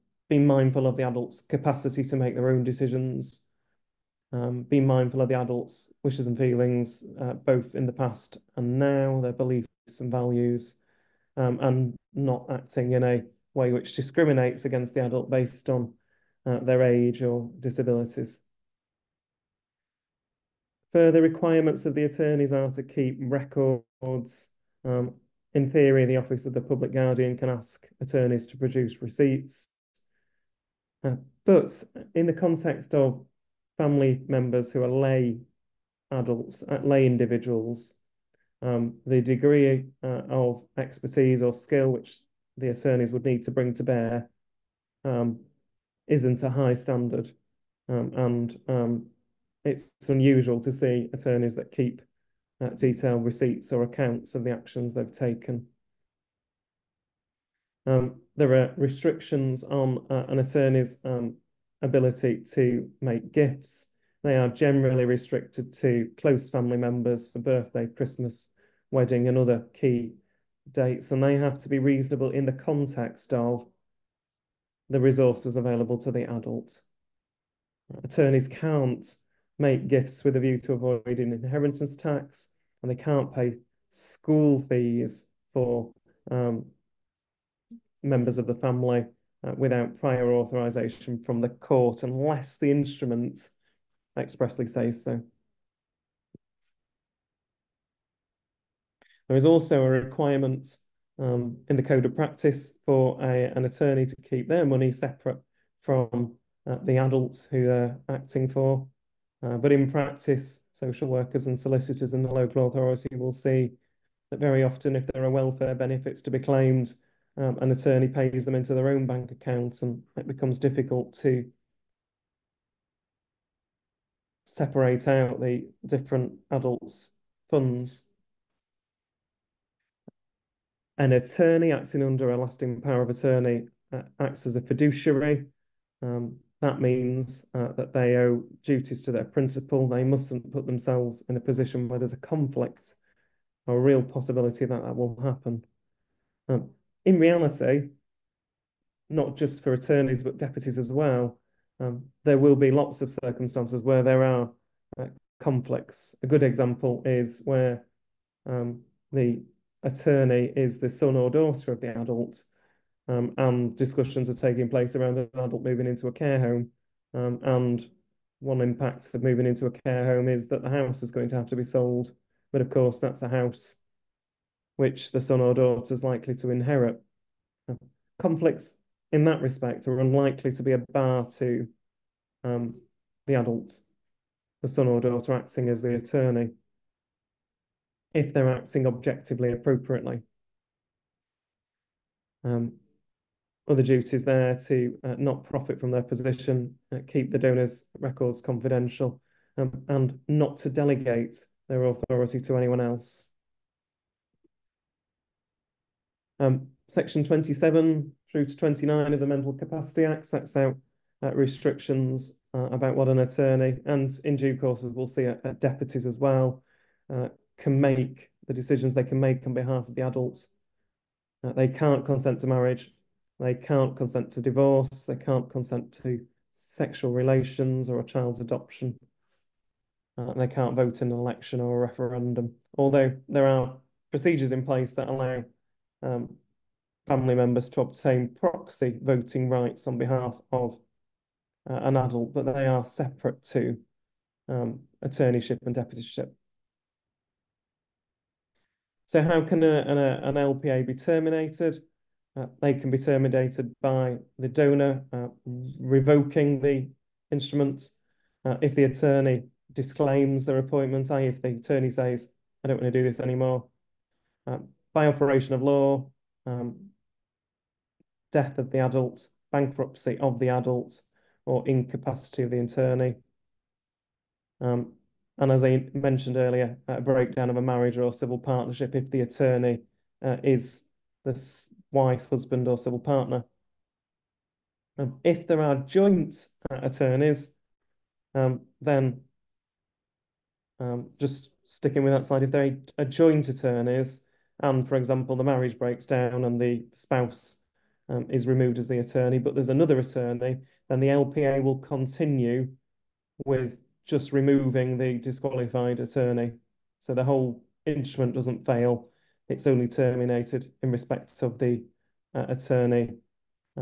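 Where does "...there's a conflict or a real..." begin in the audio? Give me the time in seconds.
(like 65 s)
141 s.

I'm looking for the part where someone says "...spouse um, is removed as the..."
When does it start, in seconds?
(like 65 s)
296 s.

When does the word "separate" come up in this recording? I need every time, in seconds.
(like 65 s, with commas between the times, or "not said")
104 s, 124 s, 242 s.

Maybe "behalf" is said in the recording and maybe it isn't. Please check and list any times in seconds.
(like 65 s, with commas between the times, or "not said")
219 s, 239 s.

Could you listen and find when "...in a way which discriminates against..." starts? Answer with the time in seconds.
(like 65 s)
12 s.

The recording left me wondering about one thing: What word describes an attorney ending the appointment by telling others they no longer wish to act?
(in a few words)
disclaims.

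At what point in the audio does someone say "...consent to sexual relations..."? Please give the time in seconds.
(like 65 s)
225 s.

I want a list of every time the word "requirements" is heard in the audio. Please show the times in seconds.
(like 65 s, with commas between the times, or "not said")
21 s, 99 s.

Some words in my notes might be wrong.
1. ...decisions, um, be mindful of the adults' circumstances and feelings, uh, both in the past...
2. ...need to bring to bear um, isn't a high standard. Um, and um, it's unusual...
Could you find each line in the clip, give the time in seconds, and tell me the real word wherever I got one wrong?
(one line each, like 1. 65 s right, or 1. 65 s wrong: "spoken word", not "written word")
1. 2 s wrong: "wishes", not "circumstances"
2. 43 s right.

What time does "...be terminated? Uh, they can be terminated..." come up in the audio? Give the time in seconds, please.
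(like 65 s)
250 s.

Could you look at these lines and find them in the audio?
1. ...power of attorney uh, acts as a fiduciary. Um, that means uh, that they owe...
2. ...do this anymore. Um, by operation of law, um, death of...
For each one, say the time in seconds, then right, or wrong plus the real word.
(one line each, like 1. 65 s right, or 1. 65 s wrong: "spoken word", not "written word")
1. 132 s right
2. 263 s right.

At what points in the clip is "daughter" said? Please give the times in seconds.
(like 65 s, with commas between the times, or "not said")
161 s, 175 s, 184 s.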